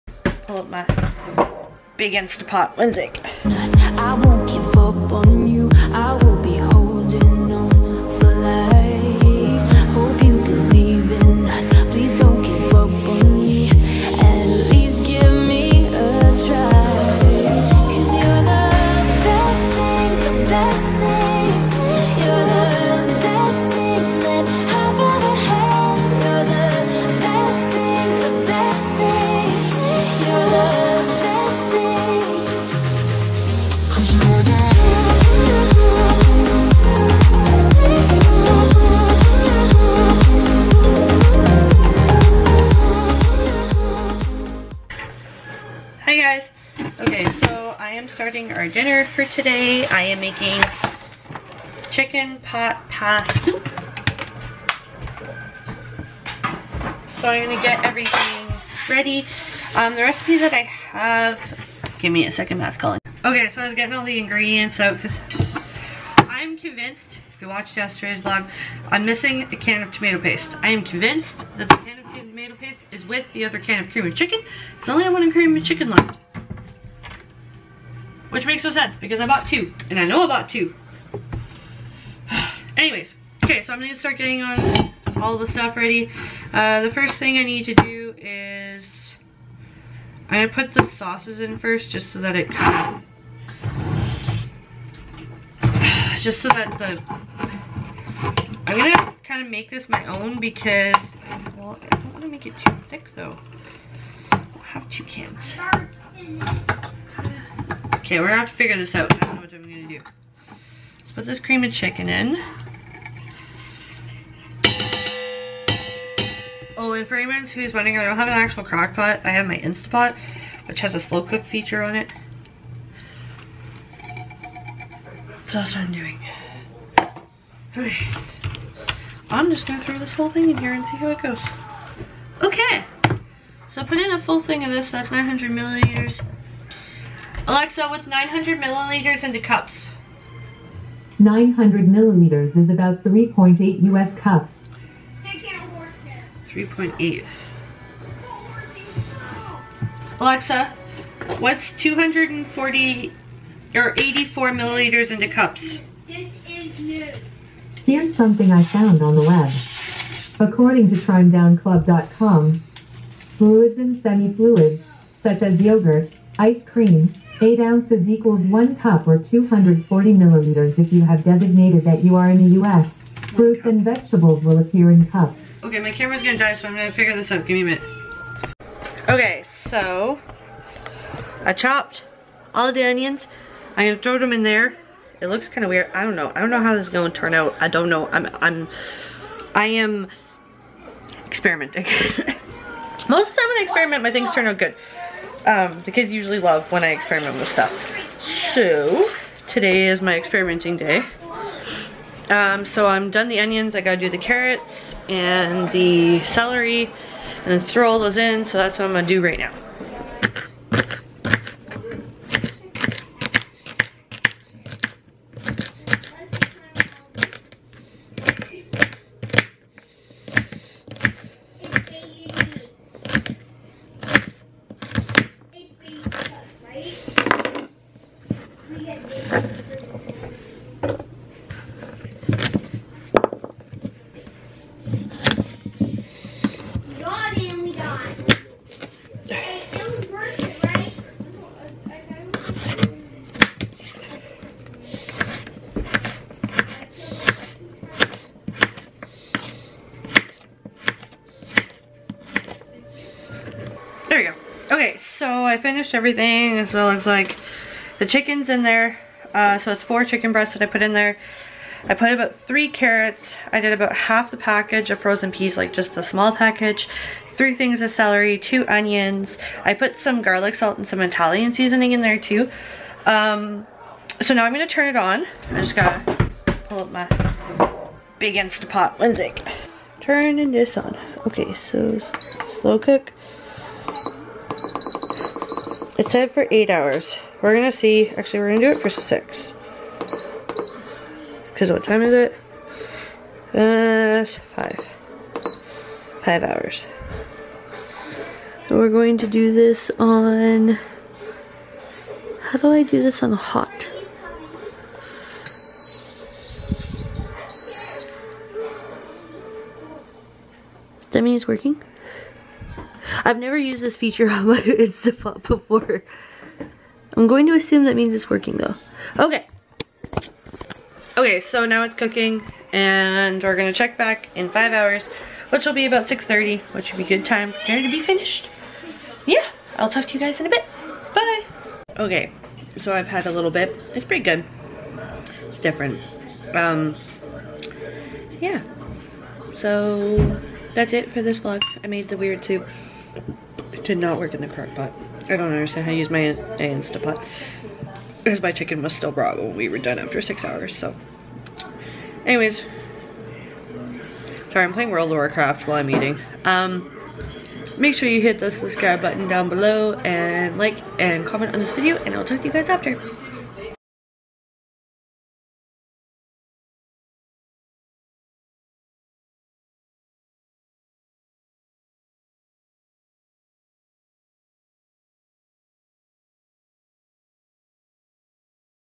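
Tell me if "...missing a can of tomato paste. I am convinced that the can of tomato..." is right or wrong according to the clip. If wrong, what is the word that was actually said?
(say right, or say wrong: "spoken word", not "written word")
right.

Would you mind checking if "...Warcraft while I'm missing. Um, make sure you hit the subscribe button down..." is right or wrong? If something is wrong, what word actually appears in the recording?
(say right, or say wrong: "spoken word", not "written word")
wrong: "eating", not "missing".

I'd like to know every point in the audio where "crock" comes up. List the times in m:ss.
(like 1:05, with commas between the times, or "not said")
1:58, 5:44.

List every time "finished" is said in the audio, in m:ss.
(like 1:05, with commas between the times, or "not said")
4:15, 5:28.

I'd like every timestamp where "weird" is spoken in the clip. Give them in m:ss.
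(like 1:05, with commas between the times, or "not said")
3:05, 5:42.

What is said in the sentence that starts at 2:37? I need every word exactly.
Here's something I found on the web.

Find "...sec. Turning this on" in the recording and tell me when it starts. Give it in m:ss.
4:39.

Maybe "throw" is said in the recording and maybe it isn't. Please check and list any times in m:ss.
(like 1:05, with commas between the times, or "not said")
2:09, 3:04, 3:27.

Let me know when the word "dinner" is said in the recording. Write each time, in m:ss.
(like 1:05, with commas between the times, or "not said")
0:48, 5:27.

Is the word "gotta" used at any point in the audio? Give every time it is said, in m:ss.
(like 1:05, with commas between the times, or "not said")
3:23, 4:35.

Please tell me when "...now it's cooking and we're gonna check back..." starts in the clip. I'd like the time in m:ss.
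5:21.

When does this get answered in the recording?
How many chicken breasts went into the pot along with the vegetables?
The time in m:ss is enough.
4:19.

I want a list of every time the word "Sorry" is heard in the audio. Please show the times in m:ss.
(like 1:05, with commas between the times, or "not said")
5:54.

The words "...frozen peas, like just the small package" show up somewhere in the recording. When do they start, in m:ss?
4:24.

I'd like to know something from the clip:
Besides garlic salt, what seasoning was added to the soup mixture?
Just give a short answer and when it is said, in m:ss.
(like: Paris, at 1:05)
Italian seasoning, at 4:31.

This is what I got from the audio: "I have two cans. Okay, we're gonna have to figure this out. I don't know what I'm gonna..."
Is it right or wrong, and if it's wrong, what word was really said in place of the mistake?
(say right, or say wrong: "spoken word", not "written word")
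right.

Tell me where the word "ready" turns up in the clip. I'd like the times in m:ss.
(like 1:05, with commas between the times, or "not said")
0:58, 1:25.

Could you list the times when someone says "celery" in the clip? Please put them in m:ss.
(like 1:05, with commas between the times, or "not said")
3:26, 4:27.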